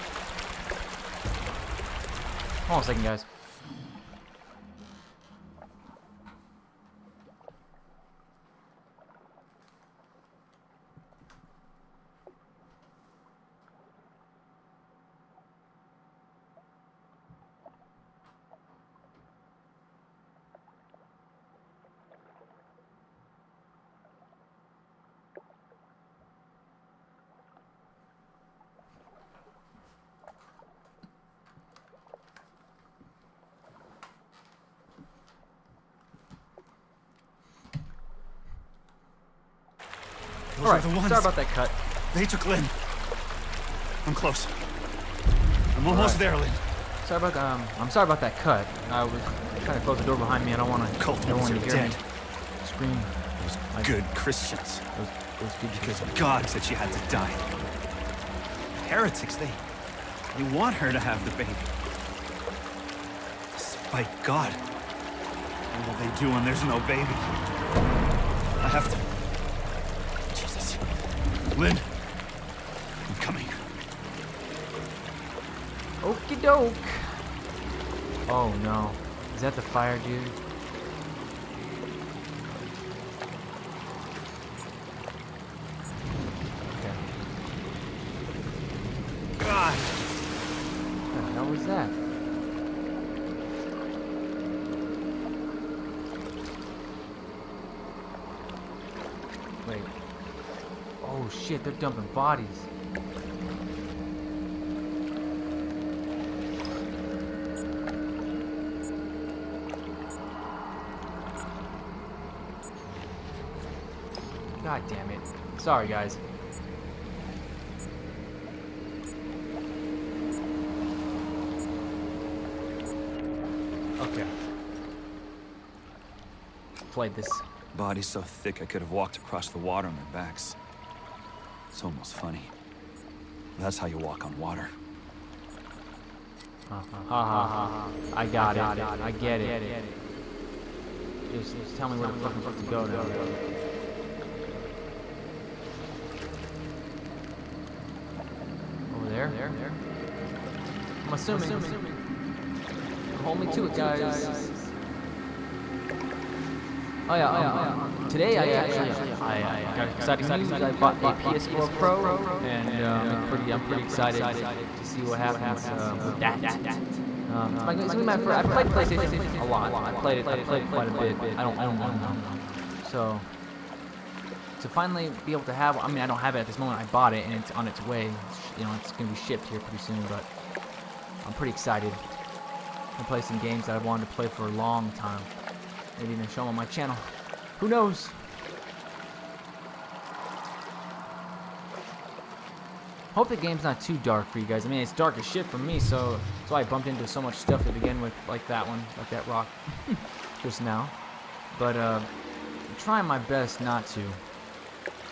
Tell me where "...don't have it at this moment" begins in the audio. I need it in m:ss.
2:56.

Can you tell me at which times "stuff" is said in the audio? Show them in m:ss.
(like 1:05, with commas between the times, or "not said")
3:17.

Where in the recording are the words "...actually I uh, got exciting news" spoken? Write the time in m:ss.
2:38.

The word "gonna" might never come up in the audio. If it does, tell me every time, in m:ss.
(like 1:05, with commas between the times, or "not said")
2:47, 2:58.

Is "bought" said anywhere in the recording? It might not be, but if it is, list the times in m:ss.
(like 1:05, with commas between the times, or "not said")
2:40, 2:56.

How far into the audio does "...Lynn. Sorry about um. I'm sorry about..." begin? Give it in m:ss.
0:46.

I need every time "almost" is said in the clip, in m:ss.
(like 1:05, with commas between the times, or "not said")
0:45, 2:11.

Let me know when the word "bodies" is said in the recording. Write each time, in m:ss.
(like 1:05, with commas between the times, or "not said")
1:42, 2:07.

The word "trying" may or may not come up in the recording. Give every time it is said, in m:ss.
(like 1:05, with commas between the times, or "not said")
0:49, 3:22.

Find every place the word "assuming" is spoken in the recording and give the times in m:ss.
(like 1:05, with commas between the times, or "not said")
2:31.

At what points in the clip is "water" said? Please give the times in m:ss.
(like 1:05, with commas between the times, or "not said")
2:09, 2:14.